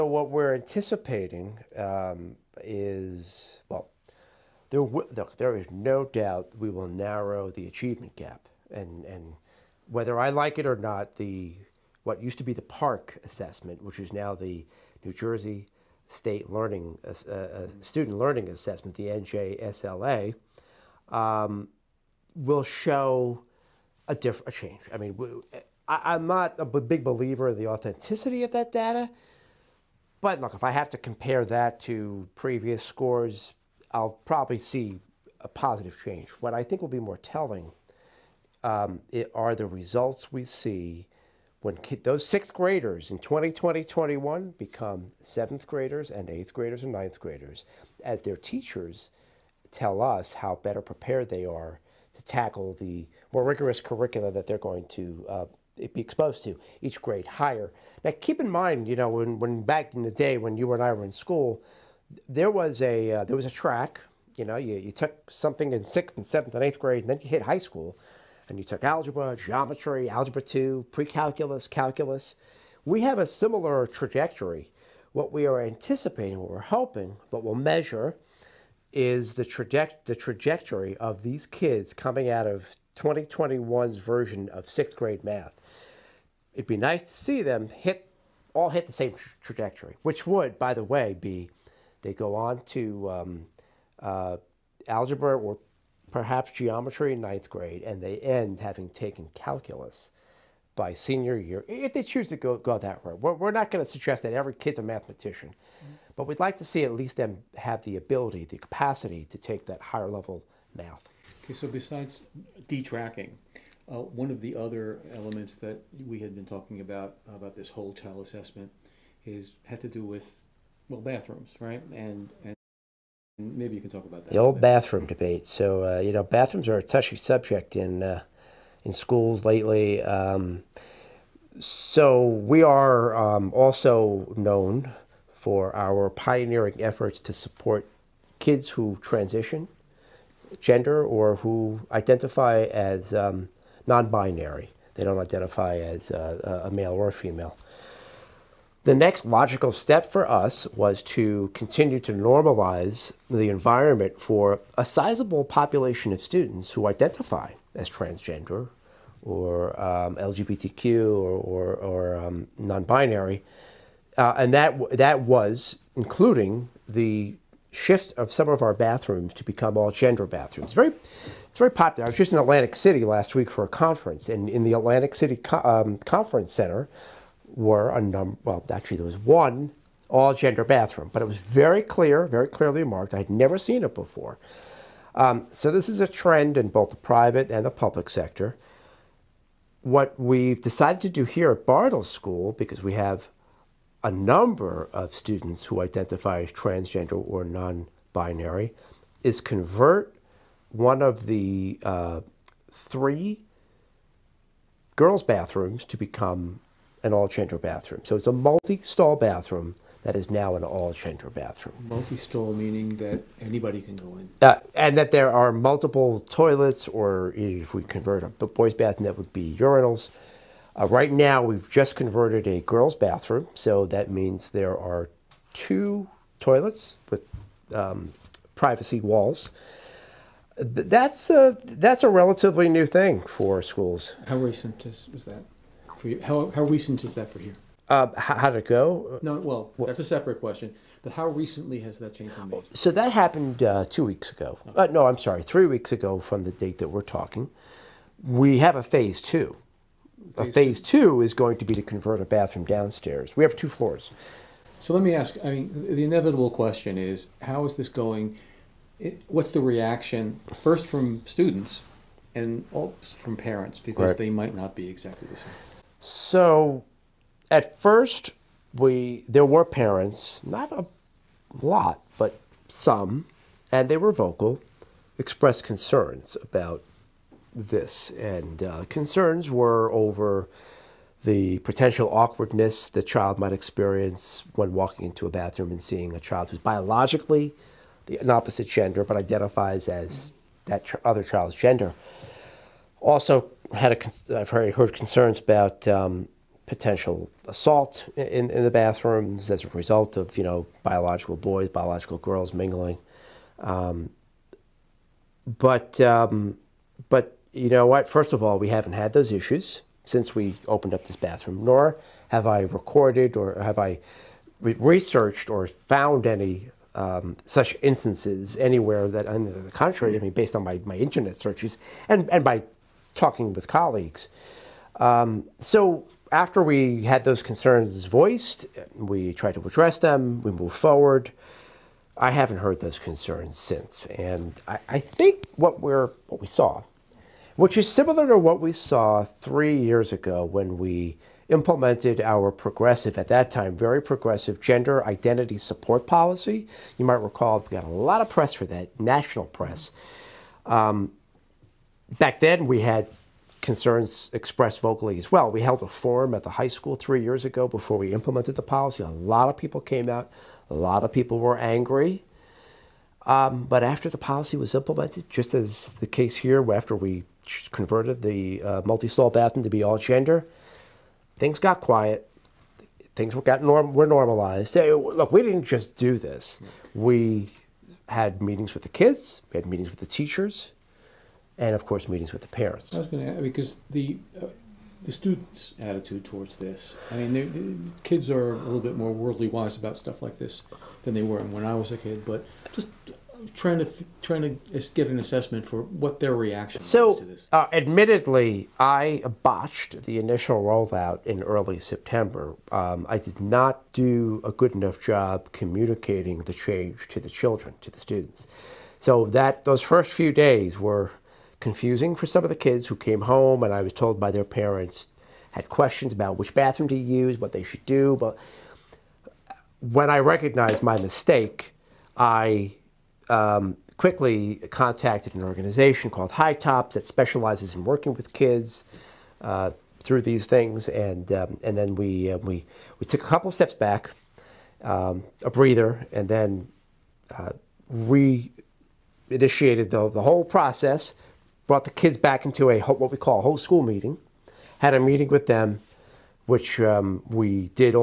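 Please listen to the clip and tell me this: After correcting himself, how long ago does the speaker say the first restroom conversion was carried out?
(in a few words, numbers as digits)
three weeks ago.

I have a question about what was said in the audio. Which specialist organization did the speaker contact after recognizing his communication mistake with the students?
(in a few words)
HiTOPS.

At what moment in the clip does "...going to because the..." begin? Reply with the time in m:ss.
6:23.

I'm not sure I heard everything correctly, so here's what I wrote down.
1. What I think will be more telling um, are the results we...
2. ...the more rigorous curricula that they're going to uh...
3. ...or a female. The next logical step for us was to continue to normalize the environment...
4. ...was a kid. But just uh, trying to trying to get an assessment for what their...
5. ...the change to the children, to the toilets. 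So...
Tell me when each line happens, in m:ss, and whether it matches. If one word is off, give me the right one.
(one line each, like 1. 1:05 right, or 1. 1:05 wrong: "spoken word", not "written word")
1. 0:36 right
2. 0:52 right
3. 2:26 right
4. 6:31 right
5. 6:46 wrong: "students", not "toilets".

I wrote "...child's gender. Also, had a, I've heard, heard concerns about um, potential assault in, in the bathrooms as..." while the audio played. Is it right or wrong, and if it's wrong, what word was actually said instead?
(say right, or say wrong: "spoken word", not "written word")
right.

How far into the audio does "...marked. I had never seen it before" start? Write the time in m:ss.
3:02.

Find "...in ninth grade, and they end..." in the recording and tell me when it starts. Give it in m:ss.
1:37.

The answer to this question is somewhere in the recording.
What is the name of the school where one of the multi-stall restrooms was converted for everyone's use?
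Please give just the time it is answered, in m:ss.
3:11.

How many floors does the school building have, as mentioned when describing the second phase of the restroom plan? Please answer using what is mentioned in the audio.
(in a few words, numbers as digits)
2.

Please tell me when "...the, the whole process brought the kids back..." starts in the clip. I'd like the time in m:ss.
7:19.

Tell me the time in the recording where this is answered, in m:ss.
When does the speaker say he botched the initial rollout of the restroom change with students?
6:41.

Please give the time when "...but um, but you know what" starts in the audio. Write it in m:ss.
5:05.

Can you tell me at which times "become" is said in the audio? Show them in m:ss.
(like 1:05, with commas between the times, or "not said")
0:44, 2:49, 3:25.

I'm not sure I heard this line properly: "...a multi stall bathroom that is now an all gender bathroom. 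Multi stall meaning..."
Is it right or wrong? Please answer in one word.
right.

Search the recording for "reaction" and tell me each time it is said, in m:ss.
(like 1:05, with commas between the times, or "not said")
4:19, 6:36.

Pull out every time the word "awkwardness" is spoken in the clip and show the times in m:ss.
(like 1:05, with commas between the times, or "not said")
4:42.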